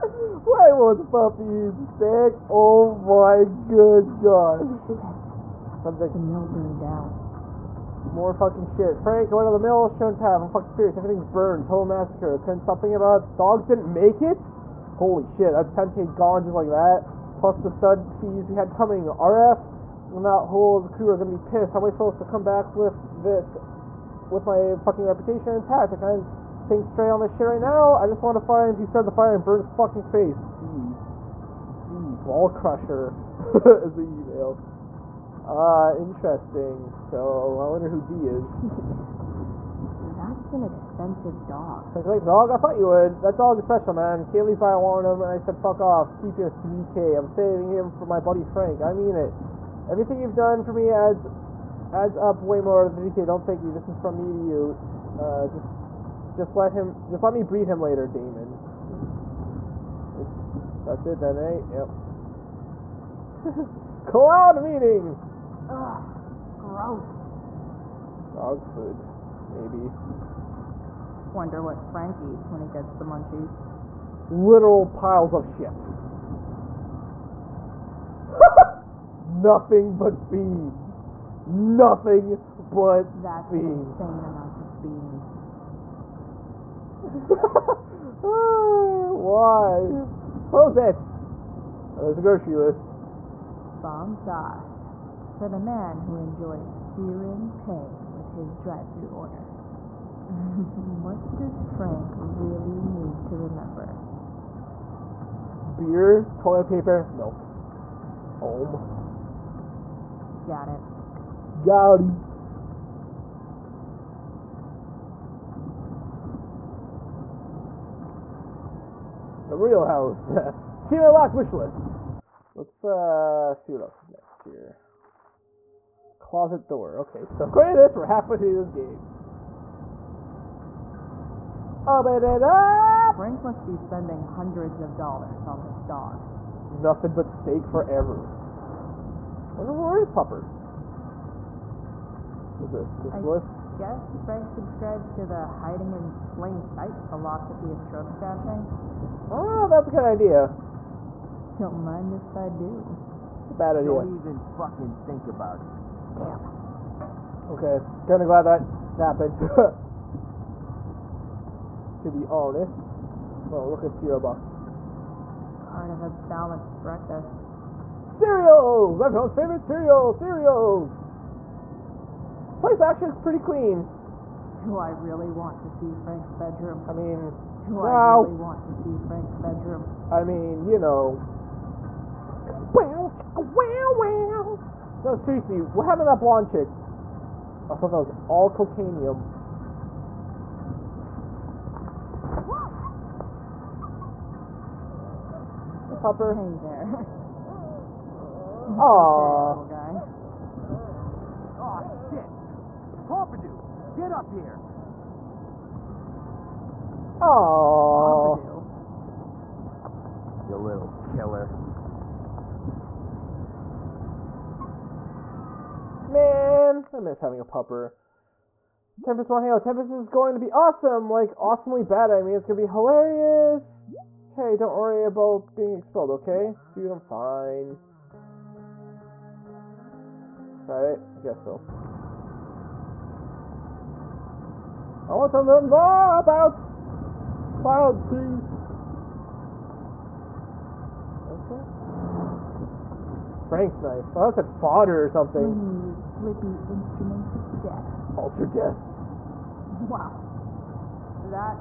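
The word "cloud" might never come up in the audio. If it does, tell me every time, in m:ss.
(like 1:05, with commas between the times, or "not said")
1:04, 3:57.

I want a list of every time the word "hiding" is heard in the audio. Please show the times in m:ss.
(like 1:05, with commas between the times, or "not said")
2:25.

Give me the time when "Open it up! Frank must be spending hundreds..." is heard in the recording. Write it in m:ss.
2:11.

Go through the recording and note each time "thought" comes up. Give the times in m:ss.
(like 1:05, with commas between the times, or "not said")
0:42, 3:07.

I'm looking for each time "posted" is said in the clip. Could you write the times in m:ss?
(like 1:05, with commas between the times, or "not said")
not said.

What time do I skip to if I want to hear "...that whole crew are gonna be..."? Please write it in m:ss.
0:20.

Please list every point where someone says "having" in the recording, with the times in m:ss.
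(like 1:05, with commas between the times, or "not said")
3:37.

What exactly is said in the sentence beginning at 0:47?
I'm saving him for my buddy Frank.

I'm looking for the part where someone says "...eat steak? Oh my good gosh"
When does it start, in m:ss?
0:01.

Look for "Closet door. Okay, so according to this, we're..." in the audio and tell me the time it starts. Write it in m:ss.
2:06.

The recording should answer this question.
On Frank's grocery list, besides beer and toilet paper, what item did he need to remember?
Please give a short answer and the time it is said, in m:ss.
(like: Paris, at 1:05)
Milk, at 1:47.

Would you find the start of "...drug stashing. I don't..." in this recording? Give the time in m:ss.
2:27.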